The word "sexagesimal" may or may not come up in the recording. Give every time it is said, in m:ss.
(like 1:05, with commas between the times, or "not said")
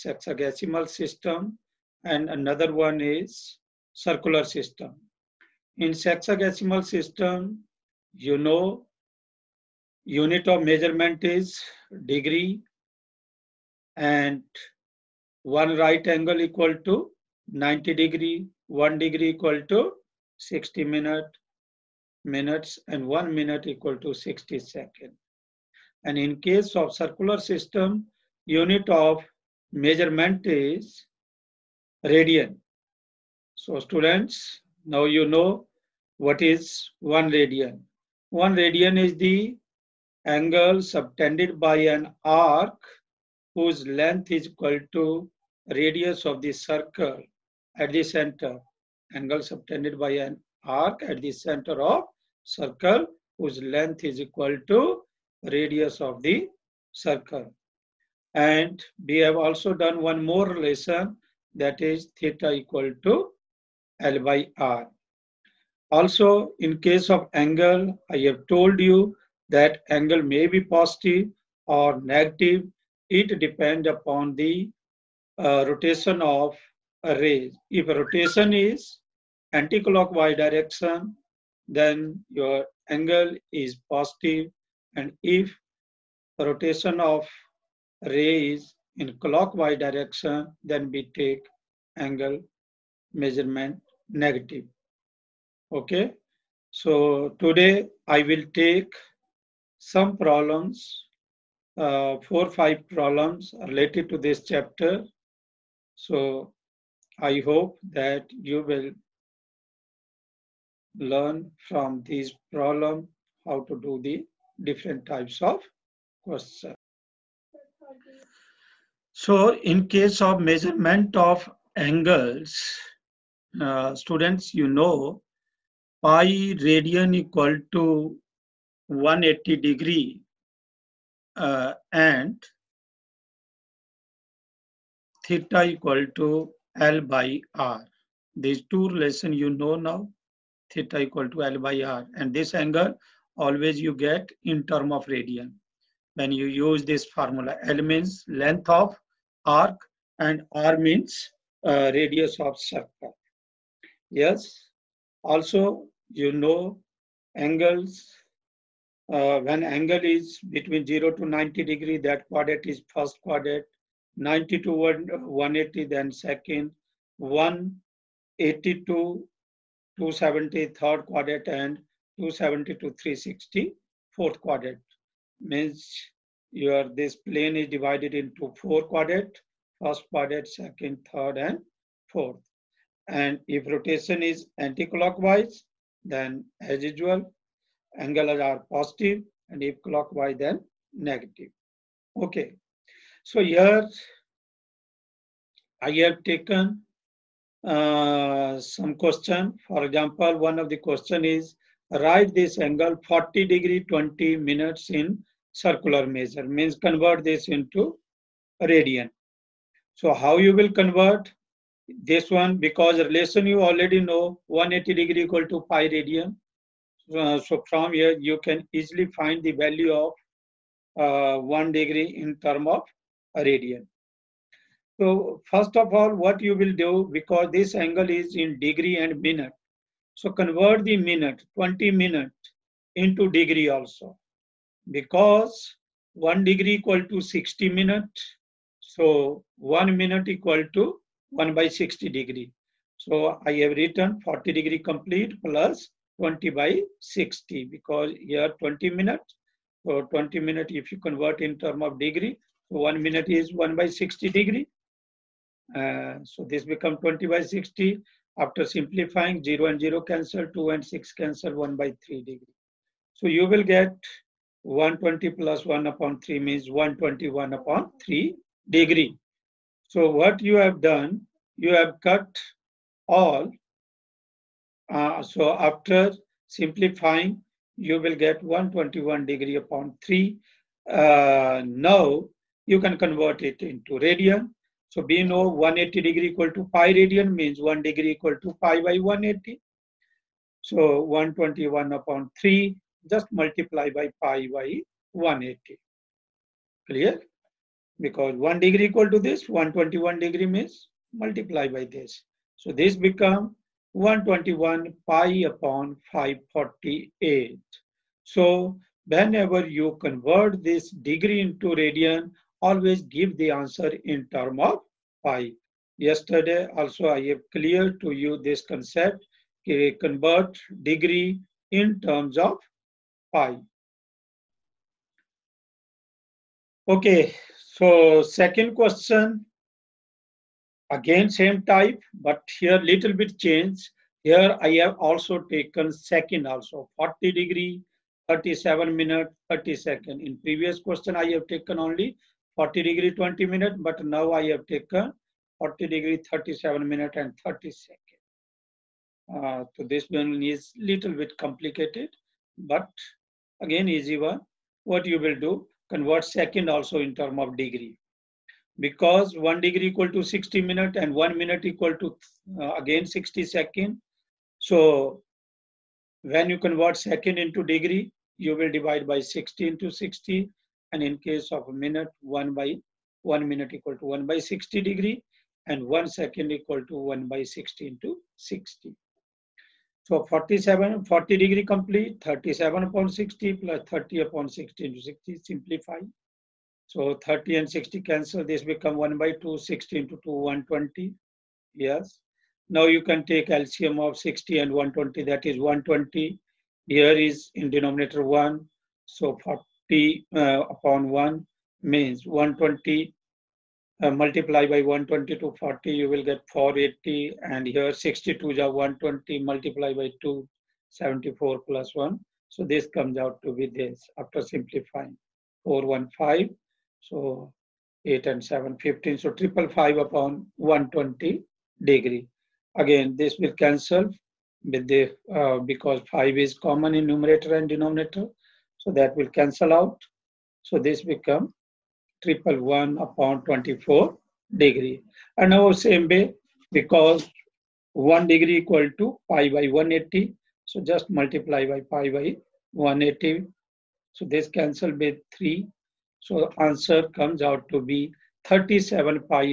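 0:00, 0:05.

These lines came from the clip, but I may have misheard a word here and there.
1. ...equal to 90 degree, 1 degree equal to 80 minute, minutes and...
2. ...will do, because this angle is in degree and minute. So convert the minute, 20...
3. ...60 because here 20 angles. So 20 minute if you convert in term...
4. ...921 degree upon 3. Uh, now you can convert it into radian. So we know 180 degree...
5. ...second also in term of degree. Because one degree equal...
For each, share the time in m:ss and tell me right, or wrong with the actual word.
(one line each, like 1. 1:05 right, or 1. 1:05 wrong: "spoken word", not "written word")
1. 0:16 wrong: "60", not "80"
2. 3:46 right
3. 4:06 wrong: "minutes", not "angles"
4. 4:38 wrong: "121", not "921"
5. 5:56 right.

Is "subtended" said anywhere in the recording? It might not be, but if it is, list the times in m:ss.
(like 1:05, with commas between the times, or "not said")
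0:40, 0:49.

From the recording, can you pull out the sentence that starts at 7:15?
And now same way, because 1 degree equal to pi by 180.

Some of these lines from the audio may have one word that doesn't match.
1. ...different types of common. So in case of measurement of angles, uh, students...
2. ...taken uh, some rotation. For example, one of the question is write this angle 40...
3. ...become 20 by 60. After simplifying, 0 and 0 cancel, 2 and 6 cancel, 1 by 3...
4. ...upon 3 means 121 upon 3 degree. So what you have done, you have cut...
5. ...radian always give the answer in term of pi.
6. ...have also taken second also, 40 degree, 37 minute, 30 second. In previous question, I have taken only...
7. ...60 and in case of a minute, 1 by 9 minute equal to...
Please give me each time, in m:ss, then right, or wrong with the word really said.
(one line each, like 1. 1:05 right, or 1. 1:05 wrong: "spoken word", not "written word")
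1. 1:54 wrong: "question", not "common"
2. 3:16 wrong: "question", not "rotation"
3. 4:16 right
4. 4:25 right
5. 5:11 right
6. 5:34 right
7. 6:09 wrong: "1", not "9".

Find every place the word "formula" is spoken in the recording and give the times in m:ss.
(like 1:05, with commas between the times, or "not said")
2:27.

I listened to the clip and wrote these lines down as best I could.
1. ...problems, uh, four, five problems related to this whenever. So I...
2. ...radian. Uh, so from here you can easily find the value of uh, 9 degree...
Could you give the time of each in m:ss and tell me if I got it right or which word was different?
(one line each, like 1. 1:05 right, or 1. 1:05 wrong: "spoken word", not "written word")
1. 1:40 wrong: "chapter", not "whenever"
2. 3:35 wrong: "1", not "9".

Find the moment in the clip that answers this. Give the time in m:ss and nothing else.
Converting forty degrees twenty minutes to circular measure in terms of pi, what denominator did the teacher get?
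5:06.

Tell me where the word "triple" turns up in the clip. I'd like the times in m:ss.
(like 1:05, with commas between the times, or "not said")
6:59, 7:12.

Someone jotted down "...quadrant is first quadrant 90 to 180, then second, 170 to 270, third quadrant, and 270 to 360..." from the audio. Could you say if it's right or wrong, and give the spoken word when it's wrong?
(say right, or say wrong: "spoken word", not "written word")
wrong: "180", not "170".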